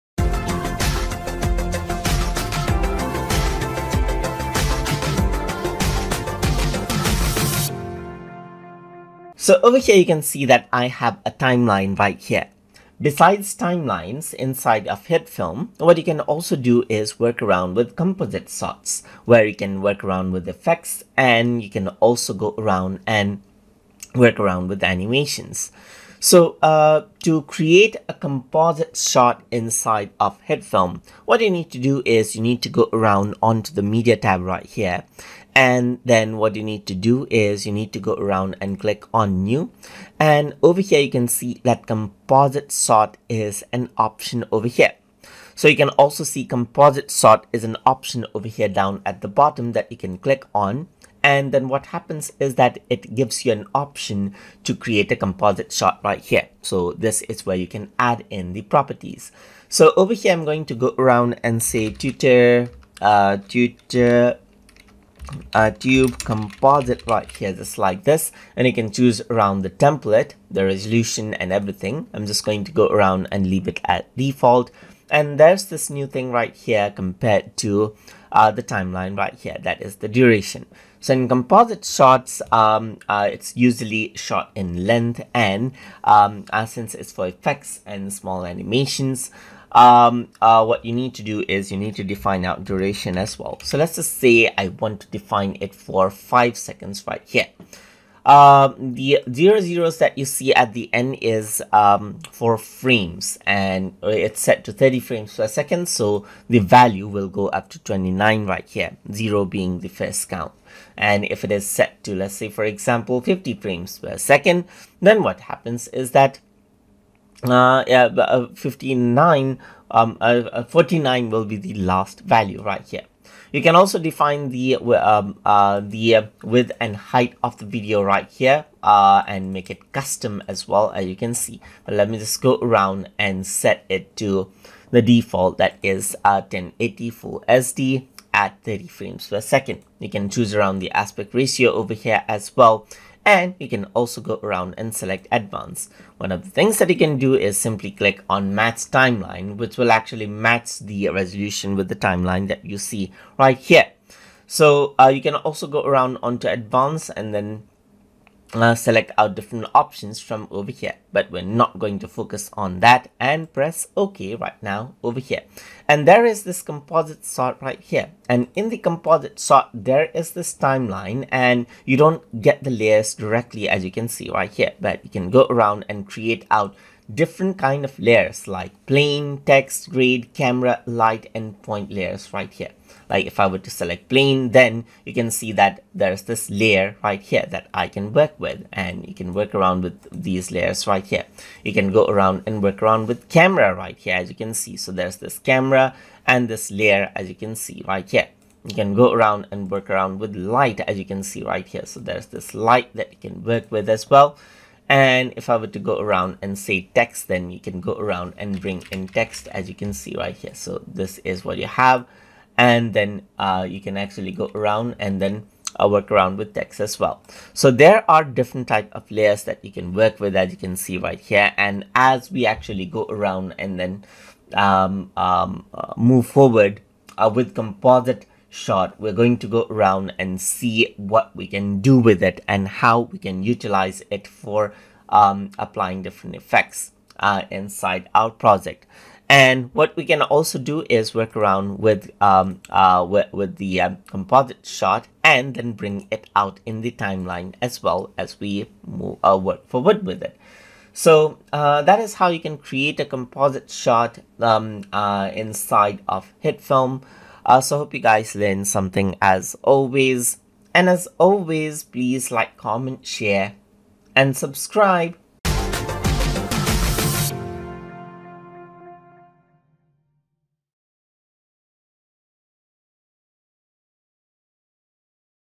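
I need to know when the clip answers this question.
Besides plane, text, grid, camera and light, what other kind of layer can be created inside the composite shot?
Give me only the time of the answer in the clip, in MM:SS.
03:01.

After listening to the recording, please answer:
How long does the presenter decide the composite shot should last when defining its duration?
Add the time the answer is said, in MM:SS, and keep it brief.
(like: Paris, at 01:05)
5 seconds, at 01:36.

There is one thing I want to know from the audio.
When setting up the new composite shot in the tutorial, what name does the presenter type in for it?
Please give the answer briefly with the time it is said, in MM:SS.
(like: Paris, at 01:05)
Tutor a tube composite, at 01:03.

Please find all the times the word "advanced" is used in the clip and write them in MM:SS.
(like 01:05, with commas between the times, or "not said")
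02:25, 02:36.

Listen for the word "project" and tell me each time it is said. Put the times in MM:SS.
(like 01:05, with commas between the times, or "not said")
03:58.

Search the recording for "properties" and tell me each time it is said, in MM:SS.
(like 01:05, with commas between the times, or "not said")
00:58.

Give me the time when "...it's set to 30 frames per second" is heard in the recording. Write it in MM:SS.
01:44.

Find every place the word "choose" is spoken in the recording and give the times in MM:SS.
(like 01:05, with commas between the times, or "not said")
01:08, 02:20.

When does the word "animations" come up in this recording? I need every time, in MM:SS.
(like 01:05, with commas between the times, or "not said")
00:24, 01:28.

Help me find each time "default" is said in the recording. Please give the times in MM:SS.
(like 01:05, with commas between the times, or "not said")
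01:14, 02:15.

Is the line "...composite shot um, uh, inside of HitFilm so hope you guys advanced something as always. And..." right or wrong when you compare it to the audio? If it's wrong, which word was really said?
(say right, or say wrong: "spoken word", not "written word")
wrong: "learned", not "advanced".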